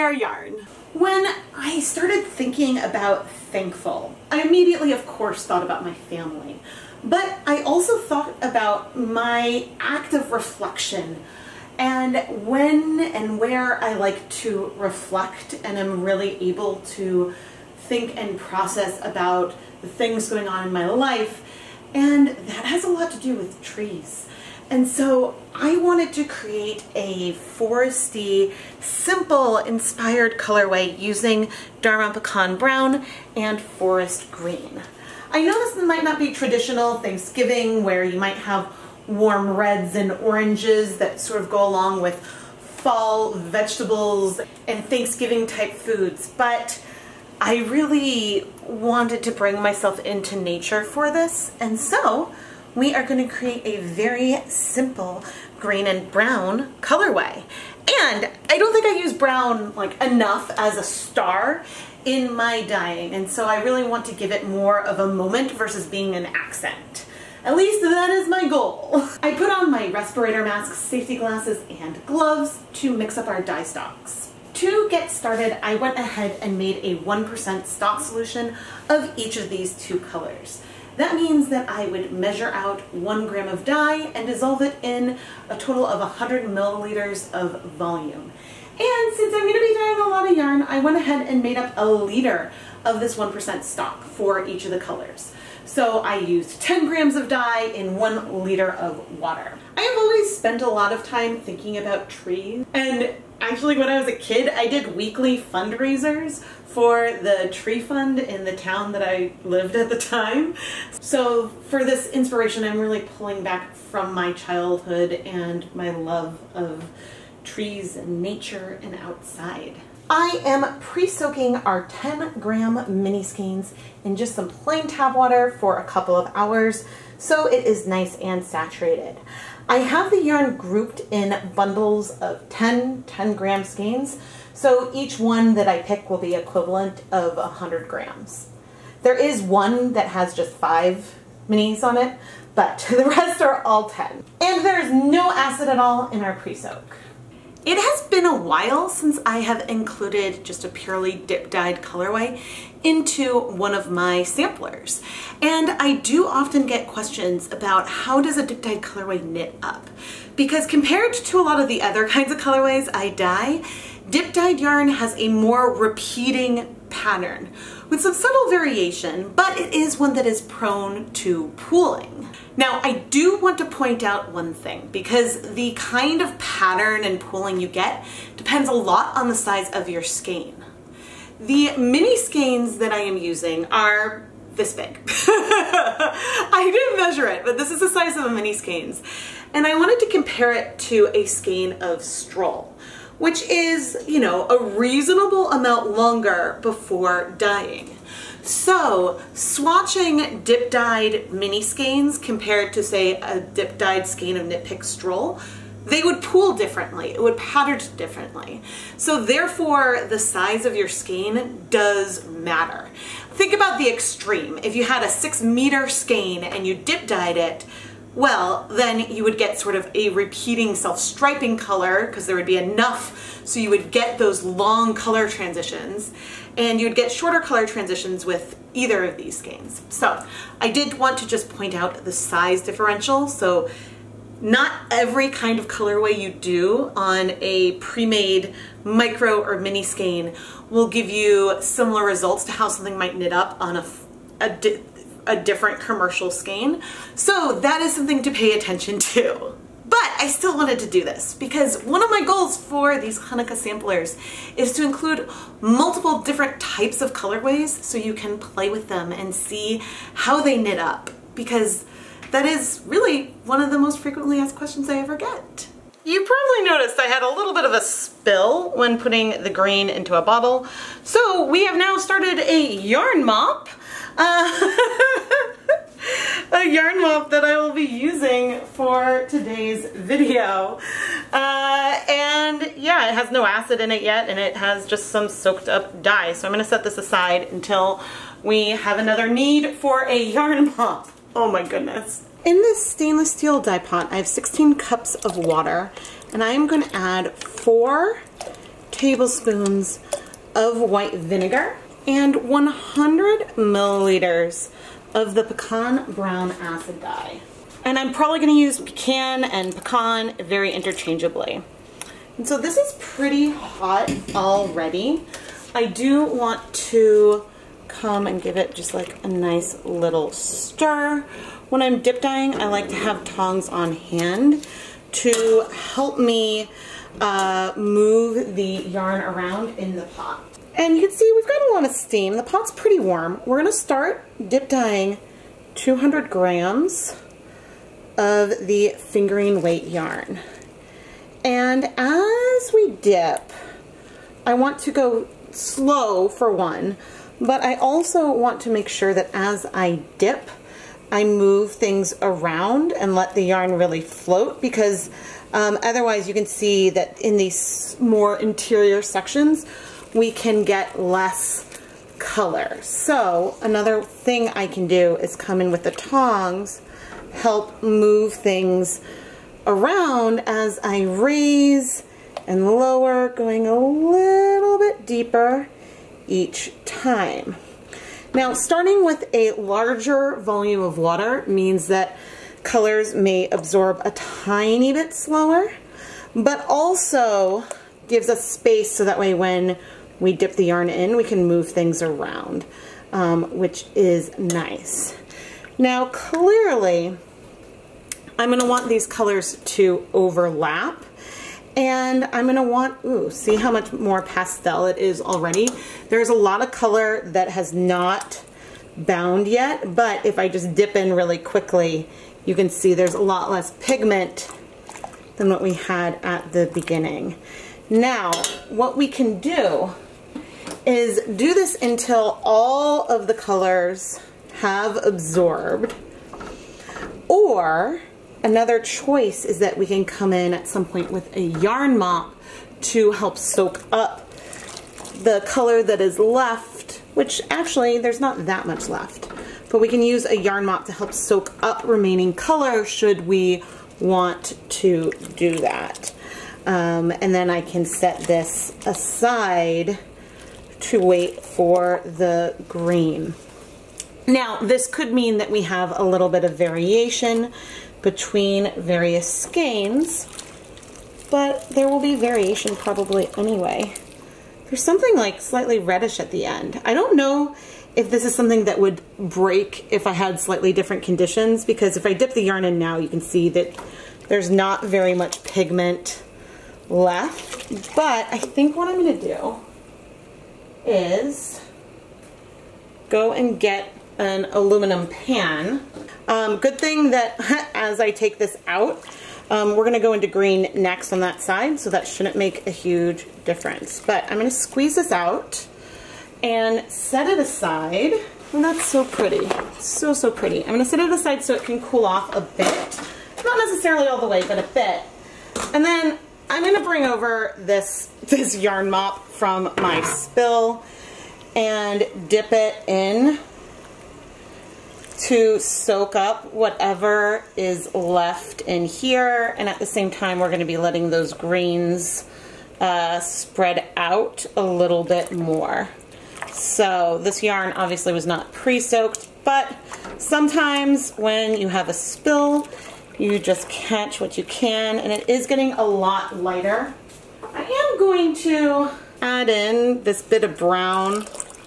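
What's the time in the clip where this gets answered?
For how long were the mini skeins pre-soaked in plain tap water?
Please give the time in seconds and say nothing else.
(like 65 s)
125 s.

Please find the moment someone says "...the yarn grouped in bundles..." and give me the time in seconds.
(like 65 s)
130 s.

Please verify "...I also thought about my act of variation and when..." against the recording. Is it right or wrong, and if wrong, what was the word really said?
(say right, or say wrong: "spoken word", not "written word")
wrong: "reflection", not "variation".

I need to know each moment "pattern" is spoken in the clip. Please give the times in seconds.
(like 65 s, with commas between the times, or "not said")
166 s, 176 s, 207 s.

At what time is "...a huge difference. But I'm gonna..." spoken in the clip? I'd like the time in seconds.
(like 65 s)
492 s.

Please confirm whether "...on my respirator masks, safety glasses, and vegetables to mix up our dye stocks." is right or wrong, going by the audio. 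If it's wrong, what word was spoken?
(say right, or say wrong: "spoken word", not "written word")
wrong: "gloves", not "vegetables".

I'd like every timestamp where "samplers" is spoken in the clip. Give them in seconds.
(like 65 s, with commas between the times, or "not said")
154 s, 253 s.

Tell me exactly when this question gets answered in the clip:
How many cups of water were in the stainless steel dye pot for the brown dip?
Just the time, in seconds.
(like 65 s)
294 s.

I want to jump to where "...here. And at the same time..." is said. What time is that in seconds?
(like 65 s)
518 s.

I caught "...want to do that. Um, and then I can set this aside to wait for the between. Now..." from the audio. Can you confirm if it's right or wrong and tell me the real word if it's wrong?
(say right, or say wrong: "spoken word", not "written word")
wrong: "green", not "between".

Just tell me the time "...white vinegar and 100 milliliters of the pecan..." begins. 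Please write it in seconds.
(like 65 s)
300 s.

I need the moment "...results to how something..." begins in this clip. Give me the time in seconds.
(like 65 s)
242 s.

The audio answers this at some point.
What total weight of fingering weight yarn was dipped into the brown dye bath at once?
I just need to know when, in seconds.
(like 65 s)
335 s.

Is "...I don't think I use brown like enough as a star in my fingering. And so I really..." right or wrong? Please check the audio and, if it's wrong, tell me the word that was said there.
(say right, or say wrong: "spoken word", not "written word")
wrong: "dyeing", not "fingering".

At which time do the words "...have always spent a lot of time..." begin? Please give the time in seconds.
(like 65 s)
99 s.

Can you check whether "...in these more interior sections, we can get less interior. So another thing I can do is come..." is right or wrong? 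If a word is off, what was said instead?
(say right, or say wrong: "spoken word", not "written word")
wrong: "color", not "interior".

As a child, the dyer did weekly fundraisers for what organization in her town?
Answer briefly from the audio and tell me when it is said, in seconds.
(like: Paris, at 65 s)
the tree fund, at 107 s.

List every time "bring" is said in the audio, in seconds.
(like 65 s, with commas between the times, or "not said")
49 s, 506 s.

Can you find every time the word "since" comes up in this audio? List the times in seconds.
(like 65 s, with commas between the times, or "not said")
89 s, 148 s.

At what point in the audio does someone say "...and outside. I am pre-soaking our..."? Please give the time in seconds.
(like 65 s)
118 s.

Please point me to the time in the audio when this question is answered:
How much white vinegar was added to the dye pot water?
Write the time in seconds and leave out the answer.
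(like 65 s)
297 s.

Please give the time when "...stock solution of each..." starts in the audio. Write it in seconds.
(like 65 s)
77 s.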